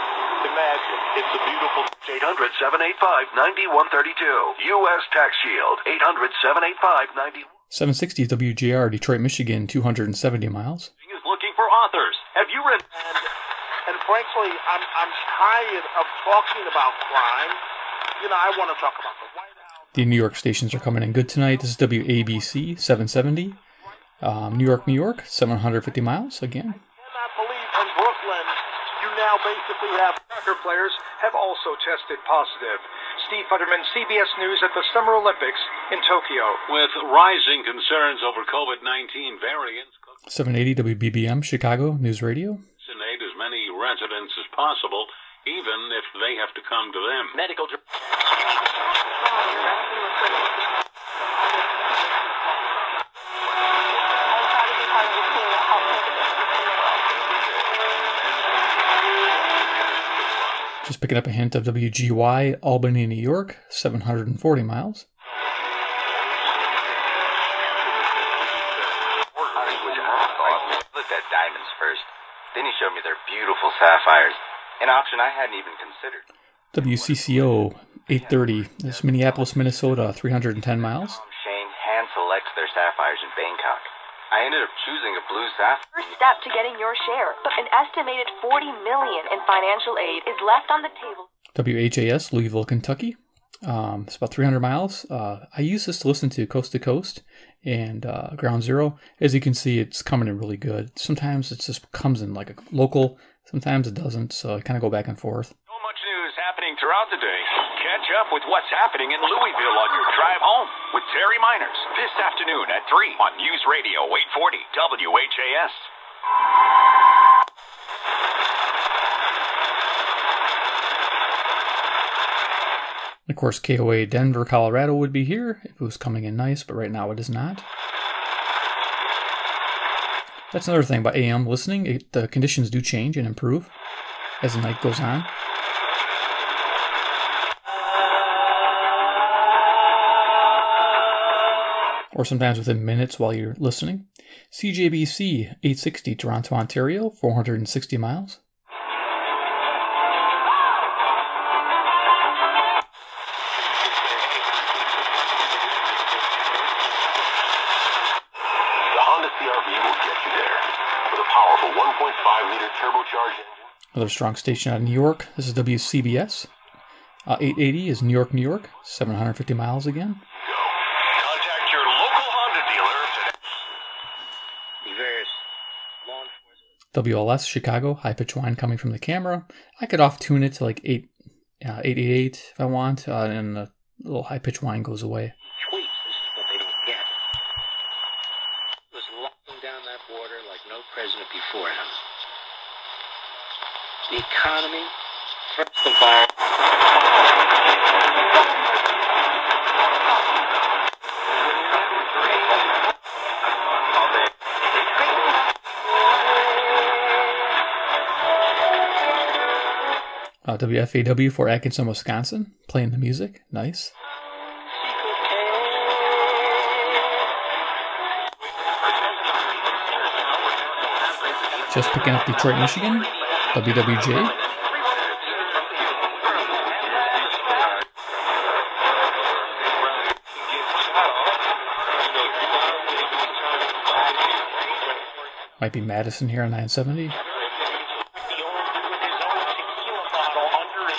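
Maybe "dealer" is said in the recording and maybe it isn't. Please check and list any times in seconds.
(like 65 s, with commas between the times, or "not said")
176 s.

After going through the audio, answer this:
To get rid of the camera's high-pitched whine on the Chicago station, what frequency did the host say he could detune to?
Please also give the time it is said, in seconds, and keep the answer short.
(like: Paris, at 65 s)
888, at 181 s.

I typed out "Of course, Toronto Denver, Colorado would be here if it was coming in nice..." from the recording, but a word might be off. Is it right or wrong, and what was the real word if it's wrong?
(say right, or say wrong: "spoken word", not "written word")
wrong: "KOA", not "Toronto".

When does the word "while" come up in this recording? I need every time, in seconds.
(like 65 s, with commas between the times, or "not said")
143 s.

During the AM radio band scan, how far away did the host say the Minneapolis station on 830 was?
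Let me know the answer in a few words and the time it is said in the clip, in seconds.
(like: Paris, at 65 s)
310 miles, at 80 s.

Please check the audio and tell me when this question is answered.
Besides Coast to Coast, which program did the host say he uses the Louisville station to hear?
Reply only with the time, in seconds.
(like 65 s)
98 s.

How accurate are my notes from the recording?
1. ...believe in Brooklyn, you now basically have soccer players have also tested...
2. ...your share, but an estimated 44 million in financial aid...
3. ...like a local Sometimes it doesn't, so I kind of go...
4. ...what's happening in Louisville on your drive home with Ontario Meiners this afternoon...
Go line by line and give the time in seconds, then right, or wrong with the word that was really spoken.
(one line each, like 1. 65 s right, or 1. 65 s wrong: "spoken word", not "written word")
1. 27 s right
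2. 86 s wrong: "40", not "44"
3. 102 s right
4. 108 s wrong: "Terry", not "Ontario".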